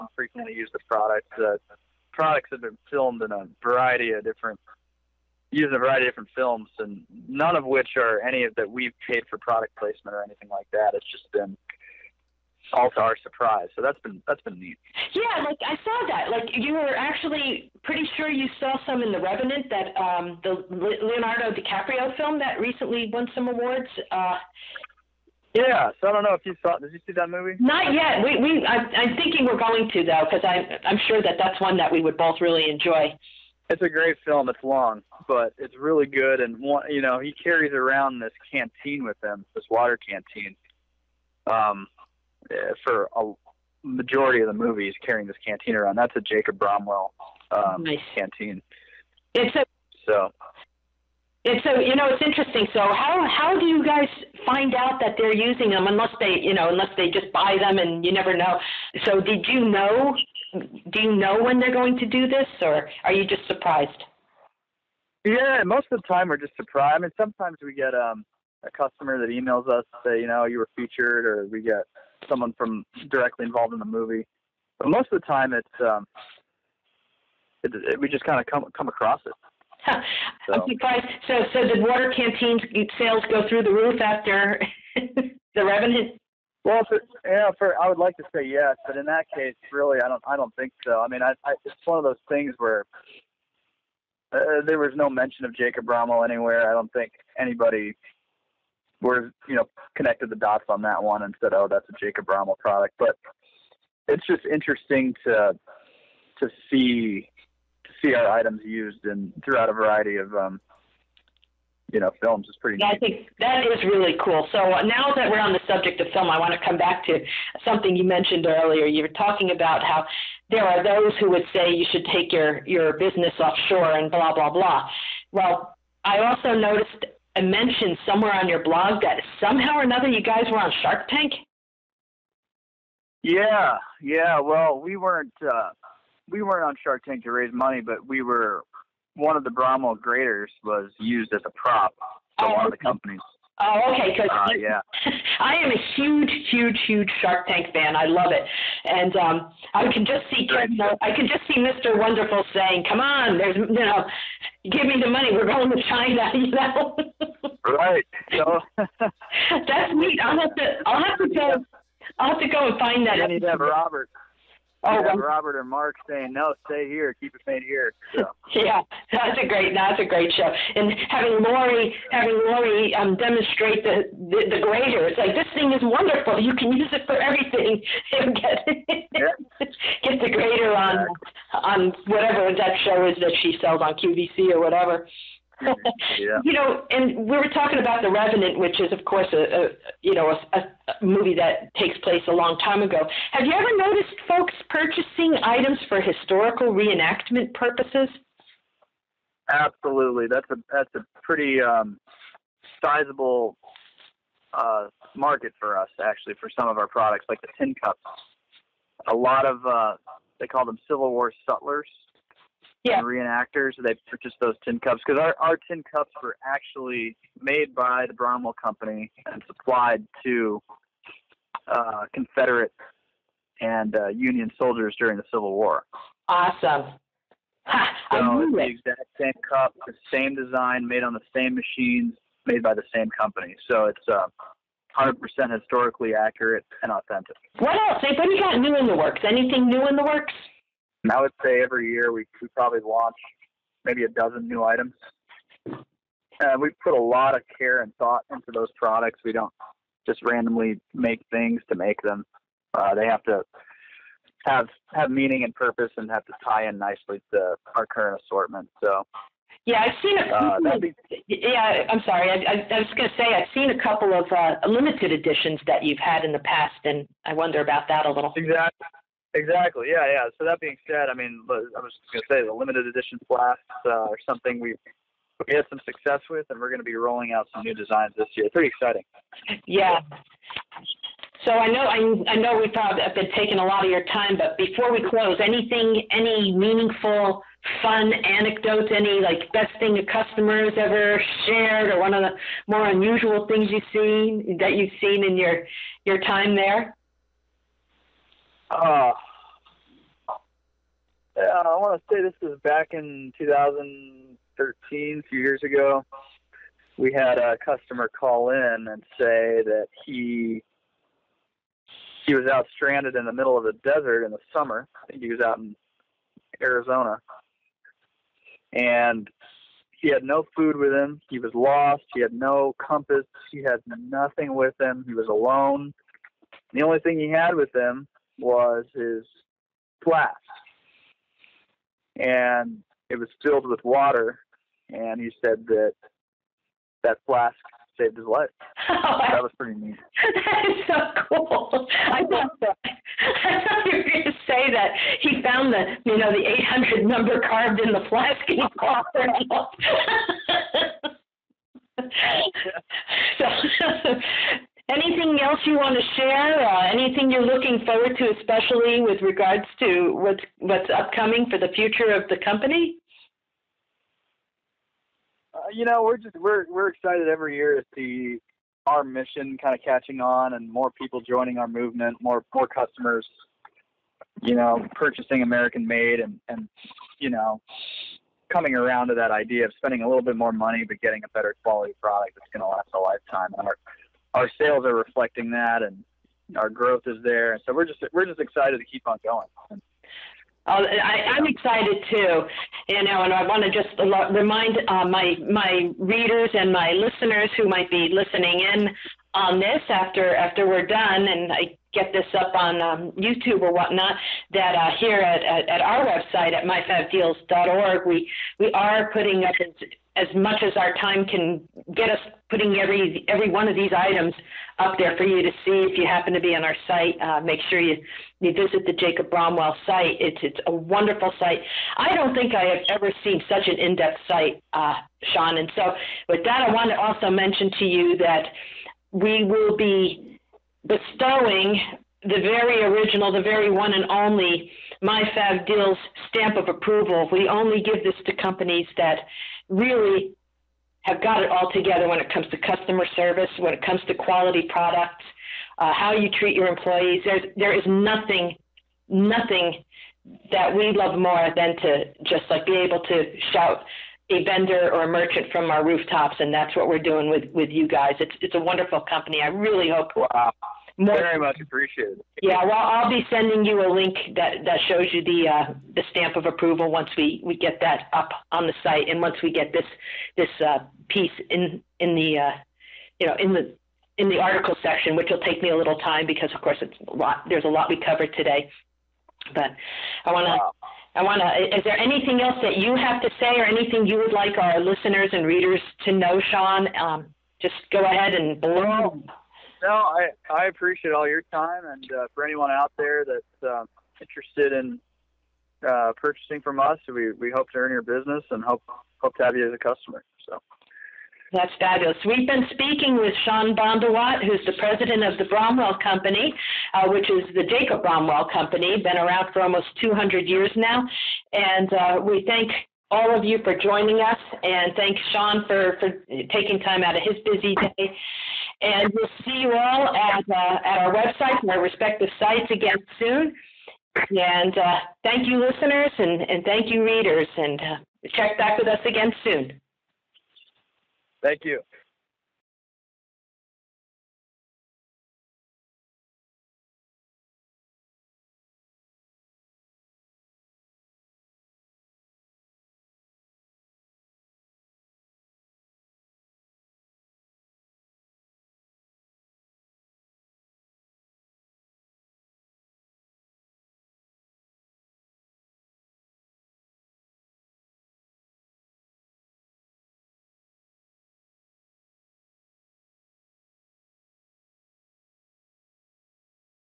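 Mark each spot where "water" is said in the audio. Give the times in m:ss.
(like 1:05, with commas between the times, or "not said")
0:39, 1:21, 5:33.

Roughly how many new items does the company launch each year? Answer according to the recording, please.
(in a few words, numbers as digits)
a dozen.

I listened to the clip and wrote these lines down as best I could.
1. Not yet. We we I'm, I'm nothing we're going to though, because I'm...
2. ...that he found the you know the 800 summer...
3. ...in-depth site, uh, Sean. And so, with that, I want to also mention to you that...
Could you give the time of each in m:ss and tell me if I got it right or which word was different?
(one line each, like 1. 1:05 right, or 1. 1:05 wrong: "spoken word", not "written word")
1. 0:27 wrong: "thinking", not "nothing"
2. 5:44 wrong: "number", not "summer"
3. 7:03 right.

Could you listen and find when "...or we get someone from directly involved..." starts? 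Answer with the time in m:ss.
1:11.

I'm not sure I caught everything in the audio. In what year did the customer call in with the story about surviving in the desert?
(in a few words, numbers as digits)
2013.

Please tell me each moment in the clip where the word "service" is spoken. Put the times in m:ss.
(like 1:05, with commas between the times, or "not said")
7:23.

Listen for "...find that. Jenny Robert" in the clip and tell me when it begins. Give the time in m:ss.
2:42.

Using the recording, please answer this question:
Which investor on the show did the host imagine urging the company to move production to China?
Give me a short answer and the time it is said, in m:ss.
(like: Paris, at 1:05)
Mr. Wonderful, at 2:31.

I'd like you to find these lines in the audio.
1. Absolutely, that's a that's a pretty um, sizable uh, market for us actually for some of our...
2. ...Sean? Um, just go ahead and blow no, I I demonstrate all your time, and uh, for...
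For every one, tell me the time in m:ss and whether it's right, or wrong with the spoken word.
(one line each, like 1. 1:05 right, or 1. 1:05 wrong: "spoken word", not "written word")
1. 3:19 right
2. 8:06 wrong: "appreciate", not "demonstrate".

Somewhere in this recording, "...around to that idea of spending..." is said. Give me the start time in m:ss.
6:18.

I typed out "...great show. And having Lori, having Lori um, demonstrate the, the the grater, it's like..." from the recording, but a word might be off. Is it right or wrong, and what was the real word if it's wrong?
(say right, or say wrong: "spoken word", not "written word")
right.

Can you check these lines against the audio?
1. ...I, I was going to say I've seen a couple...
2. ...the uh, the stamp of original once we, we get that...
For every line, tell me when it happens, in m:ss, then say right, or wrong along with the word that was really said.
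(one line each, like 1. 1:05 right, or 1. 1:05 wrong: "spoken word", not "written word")
1. 4:22 right
2. 7:45 wrong: "approval", not "original".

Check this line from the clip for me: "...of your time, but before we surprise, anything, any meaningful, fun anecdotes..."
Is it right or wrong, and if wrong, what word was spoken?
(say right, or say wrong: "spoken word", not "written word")
wrong: "close", not "surprise".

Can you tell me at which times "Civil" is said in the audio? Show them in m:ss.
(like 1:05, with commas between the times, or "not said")
3:30, 3:45.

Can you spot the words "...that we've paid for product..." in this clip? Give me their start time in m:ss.
0:08.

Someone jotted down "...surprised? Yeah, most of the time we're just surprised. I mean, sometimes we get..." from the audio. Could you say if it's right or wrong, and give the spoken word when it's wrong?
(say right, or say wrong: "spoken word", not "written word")
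right.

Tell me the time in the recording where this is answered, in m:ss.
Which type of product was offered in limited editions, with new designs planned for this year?
4:33.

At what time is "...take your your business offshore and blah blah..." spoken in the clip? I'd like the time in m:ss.
2:02.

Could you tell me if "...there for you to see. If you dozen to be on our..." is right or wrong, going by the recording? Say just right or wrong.
wrong.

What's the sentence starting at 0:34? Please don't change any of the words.
It's long, but it's really good.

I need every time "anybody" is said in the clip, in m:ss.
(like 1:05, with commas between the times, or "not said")
1:37, 3:58.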